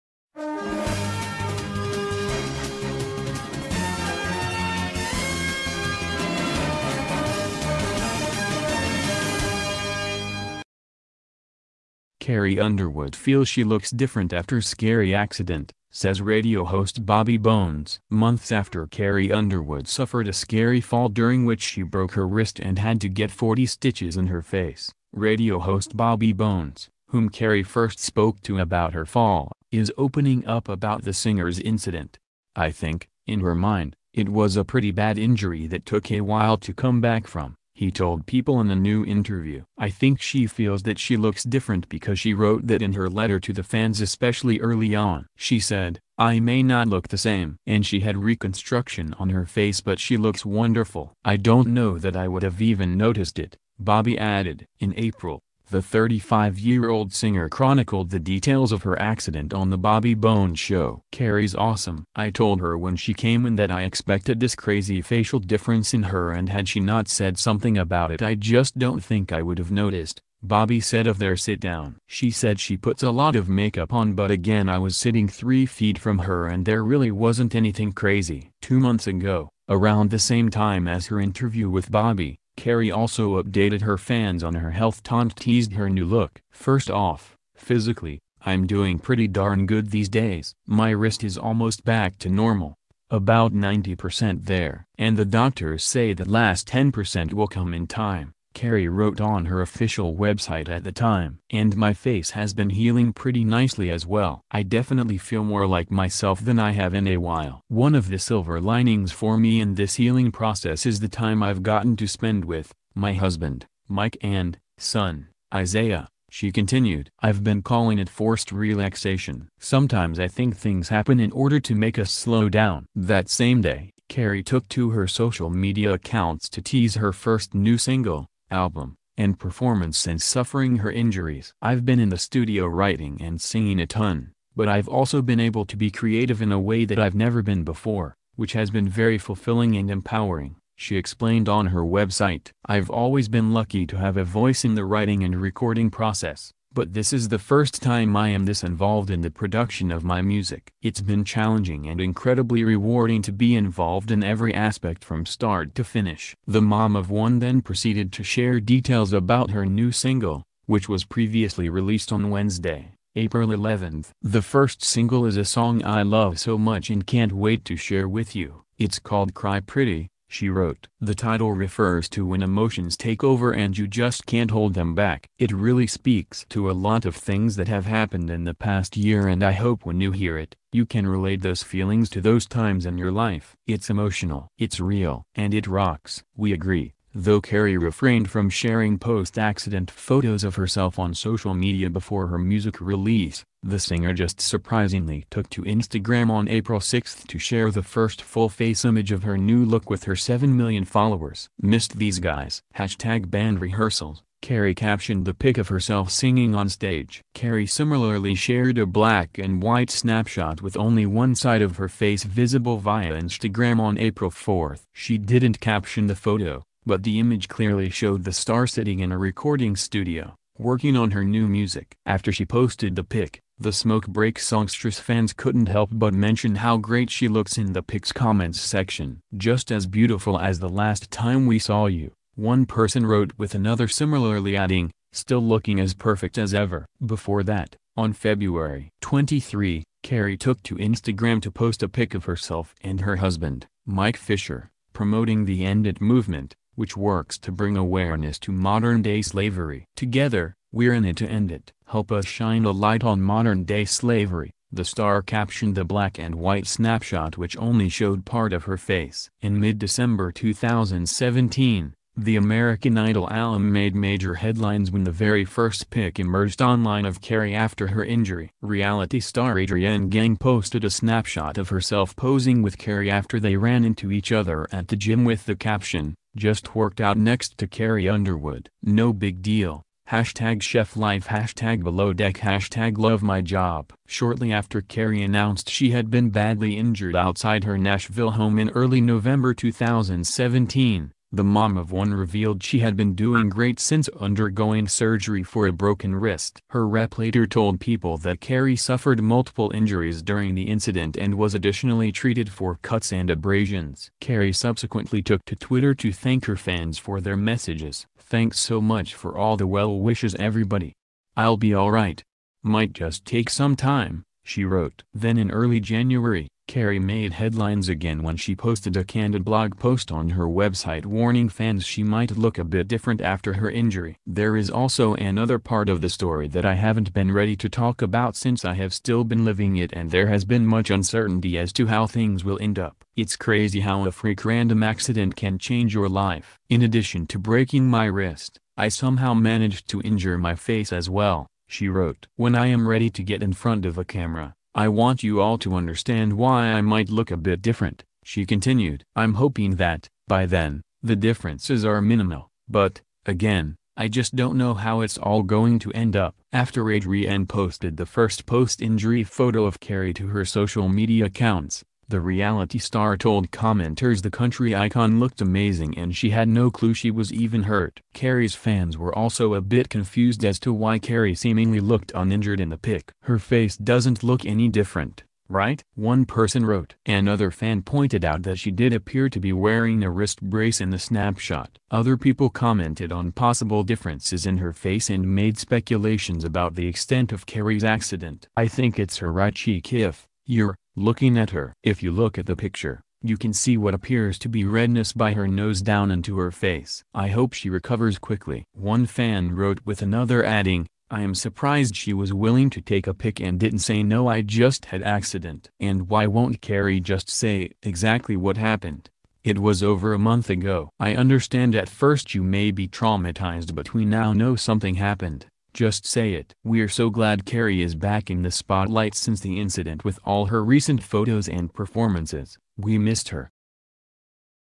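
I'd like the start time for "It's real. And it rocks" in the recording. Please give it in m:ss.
3:04.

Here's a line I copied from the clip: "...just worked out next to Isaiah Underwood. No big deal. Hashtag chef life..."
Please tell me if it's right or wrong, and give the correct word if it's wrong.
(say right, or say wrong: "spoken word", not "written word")
wrong: "Carrie", not "Isaiah".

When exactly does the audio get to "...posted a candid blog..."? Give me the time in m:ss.
5:18.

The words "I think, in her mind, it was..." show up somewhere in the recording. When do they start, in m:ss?
0:32.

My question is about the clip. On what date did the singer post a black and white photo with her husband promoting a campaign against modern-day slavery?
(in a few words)
February 23.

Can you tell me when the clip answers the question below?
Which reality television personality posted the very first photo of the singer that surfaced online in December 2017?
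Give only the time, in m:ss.
4:29.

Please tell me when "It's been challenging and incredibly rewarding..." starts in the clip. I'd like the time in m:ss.
2:30.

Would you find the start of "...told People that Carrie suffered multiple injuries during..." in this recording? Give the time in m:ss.
4:57.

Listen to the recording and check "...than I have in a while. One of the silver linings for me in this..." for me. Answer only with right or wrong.
right.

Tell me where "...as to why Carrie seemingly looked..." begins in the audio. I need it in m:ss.
6:10.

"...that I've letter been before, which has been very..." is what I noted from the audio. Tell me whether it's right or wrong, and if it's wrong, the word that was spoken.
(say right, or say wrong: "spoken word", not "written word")
wrong: "never", not "letter".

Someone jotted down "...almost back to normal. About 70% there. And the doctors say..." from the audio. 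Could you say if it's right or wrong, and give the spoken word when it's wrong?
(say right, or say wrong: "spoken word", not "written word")
wrong: "90", not "70".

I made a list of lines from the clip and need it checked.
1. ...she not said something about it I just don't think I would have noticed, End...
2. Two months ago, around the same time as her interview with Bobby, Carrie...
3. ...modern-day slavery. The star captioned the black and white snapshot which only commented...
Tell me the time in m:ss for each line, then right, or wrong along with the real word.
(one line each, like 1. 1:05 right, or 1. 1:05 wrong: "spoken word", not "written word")
1. 1:06 wrong: "Bobby", not "End"
2. 1:18 right
3. 4:13 wrong: "showed", not "commented".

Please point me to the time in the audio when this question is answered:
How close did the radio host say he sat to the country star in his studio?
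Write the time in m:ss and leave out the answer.
1:15.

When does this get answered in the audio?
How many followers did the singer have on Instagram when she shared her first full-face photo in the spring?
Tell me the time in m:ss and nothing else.
3:20.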